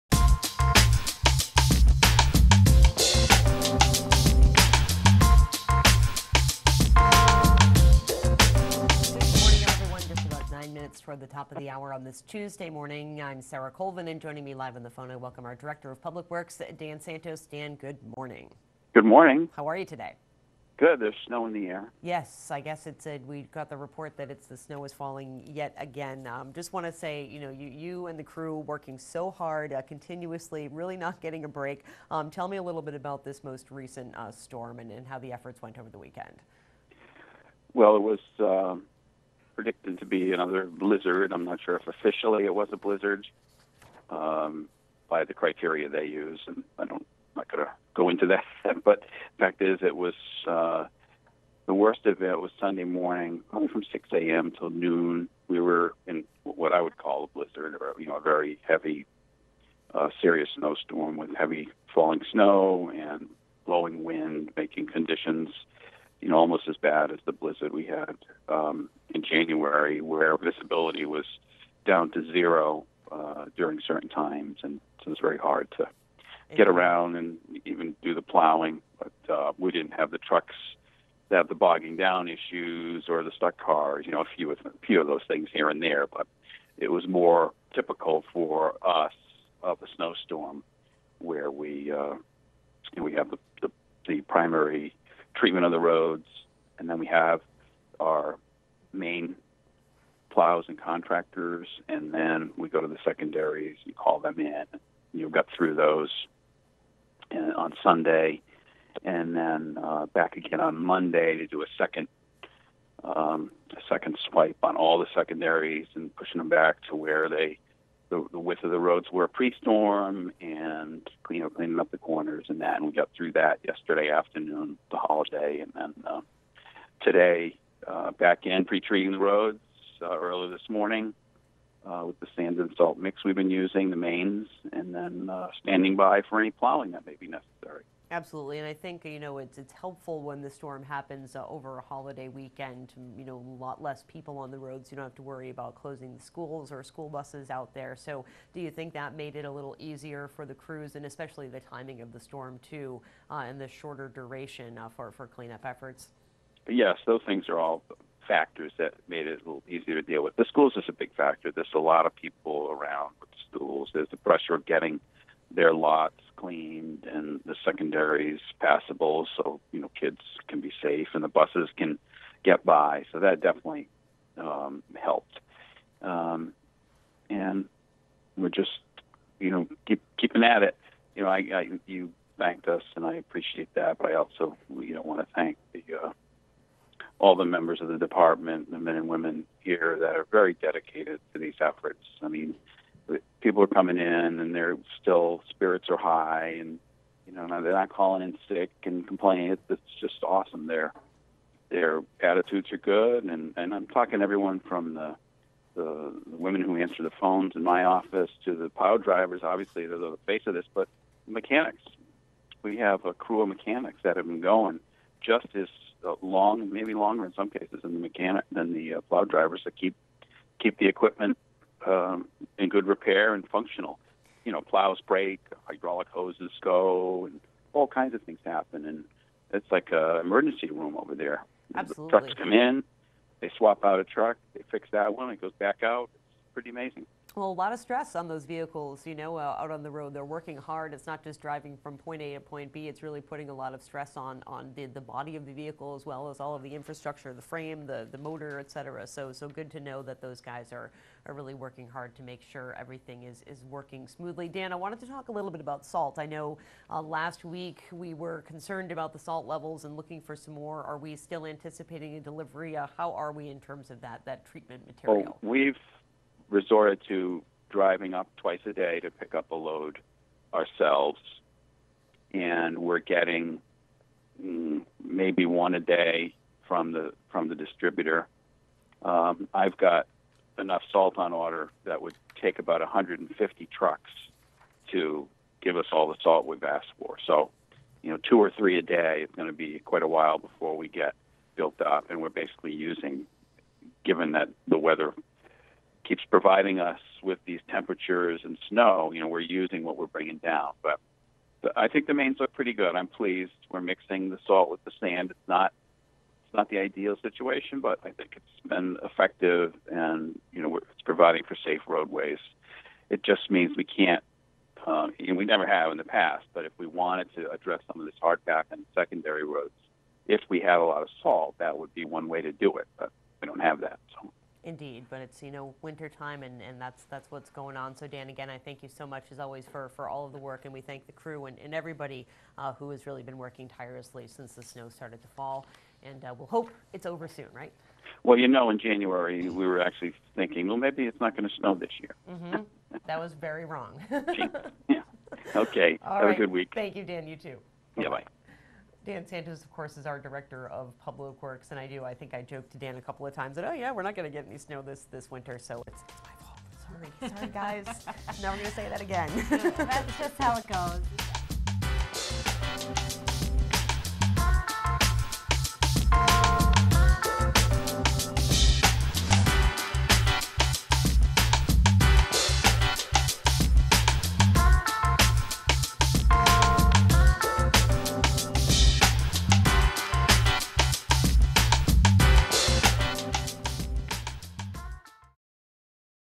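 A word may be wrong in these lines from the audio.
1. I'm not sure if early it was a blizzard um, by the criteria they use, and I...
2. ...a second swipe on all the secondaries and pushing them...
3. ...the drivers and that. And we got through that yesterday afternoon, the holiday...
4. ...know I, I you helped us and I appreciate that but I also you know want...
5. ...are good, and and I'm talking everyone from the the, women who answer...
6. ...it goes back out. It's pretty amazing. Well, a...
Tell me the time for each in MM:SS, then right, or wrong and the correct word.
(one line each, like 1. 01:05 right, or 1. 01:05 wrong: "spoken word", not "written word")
1. 00:41 wrong: "officially", not "early"
2. 01:53 right
3. 02:01 wrong: "corners", not "drivers"
4. 03:01 wrong: "thanked", not "helped"
5. 03:22 right
6. 03:55 right.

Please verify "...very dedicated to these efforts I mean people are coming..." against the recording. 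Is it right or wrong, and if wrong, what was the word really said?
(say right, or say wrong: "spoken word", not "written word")
right.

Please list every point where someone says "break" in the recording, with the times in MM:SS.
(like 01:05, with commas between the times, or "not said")
00:31, 03:45.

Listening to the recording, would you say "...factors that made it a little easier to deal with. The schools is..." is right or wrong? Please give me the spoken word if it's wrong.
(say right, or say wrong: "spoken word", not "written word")
right.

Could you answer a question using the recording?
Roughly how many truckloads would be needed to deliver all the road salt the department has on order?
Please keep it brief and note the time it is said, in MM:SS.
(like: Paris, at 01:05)
150, at 04:42.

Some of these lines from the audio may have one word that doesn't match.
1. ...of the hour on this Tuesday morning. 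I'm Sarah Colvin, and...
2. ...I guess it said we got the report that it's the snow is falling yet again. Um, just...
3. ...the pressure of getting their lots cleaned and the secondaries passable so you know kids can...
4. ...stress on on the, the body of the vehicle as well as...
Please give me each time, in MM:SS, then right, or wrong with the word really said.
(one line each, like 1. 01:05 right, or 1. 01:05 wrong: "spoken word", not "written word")
1. 00:11 right
2. 00:22 right
3. 02:44 right
4. 04:03 right.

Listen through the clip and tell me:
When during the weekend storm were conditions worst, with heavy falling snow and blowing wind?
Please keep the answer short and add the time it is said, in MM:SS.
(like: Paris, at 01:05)
Sunday morning, at 00:52.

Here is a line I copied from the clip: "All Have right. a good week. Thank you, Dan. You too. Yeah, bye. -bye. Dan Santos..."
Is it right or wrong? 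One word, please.
right.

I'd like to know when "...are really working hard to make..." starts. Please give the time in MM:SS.
04:11.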